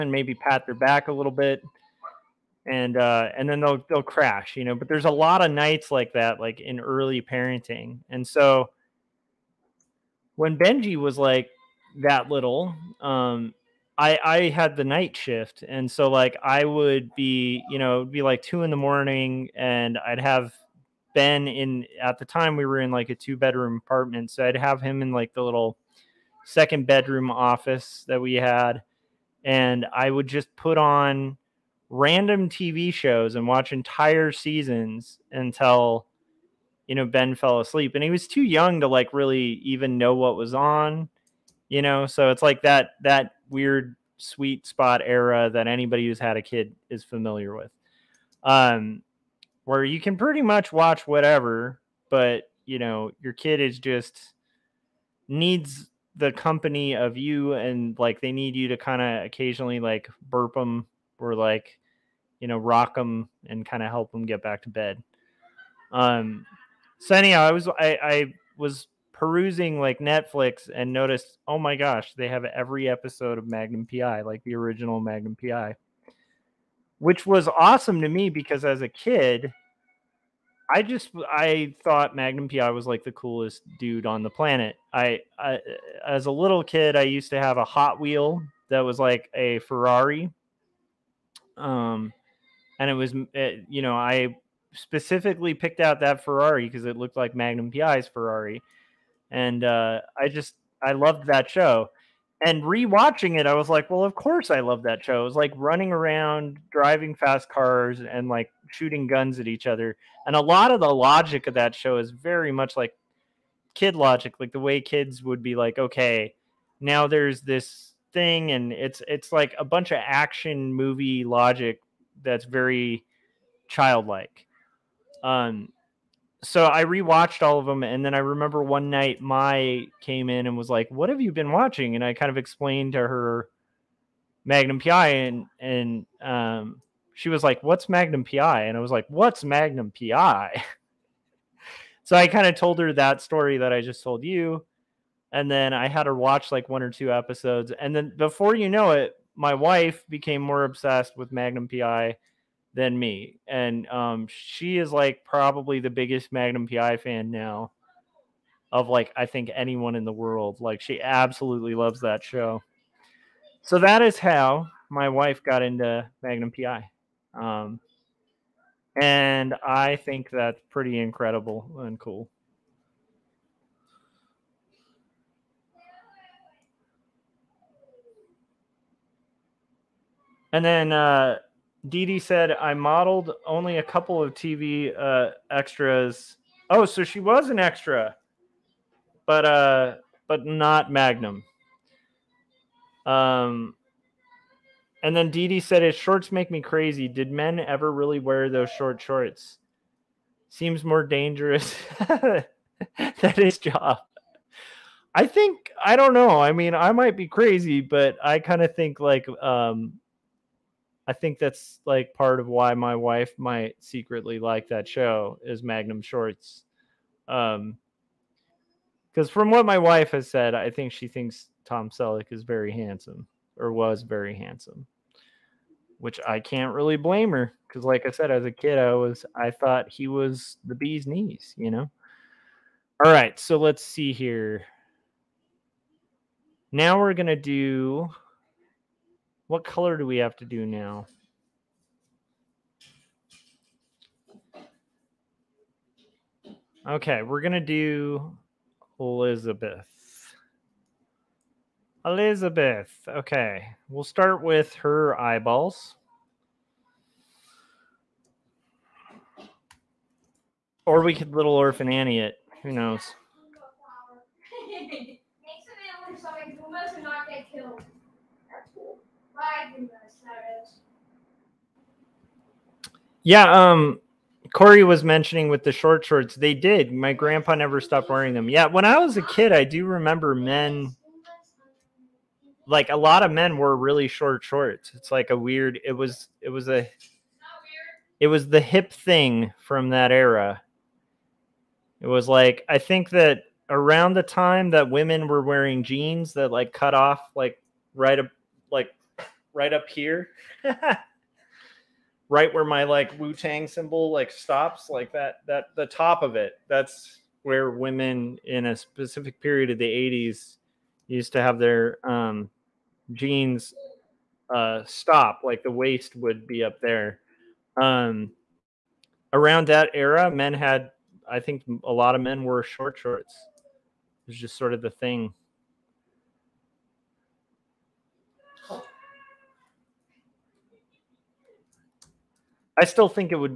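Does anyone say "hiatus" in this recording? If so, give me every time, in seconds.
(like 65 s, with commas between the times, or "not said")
not said.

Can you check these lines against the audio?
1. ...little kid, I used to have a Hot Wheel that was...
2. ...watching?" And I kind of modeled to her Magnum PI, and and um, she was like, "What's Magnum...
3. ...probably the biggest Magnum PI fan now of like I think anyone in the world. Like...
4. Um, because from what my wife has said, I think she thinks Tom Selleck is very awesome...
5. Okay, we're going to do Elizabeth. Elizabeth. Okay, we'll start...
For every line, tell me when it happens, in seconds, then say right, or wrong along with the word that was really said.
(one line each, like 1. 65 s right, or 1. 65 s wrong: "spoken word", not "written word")
1. 86 s right
2. 131 s wrong: "explained", not "modeled"
3. 155 s right
4. 217 s wrong: "handsome", not "awesome"
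5. 246 s right.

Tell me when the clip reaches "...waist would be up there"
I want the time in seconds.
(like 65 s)
315 s.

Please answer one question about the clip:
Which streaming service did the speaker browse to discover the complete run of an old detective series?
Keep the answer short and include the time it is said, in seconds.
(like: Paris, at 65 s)
Netflix, at 69 s.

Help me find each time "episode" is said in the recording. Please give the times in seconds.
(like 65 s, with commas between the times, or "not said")
72 s, 147 s.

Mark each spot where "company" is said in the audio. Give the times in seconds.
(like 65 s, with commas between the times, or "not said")
56 s.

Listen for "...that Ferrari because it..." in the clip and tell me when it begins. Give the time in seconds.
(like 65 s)
96 s.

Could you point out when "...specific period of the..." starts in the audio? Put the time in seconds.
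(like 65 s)
308 s.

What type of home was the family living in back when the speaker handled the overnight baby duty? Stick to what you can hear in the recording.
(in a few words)
two bedroom apartment.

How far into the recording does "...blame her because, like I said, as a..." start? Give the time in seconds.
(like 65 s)
226 s.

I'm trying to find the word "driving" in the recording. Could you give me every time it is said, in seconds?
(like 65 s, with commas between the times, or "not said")
106 s.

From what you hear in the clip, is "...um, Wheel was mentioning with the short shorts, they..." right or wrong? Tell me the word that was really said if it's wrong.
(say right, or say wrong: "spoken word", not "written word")
wrong: "Corey", not "Wheel".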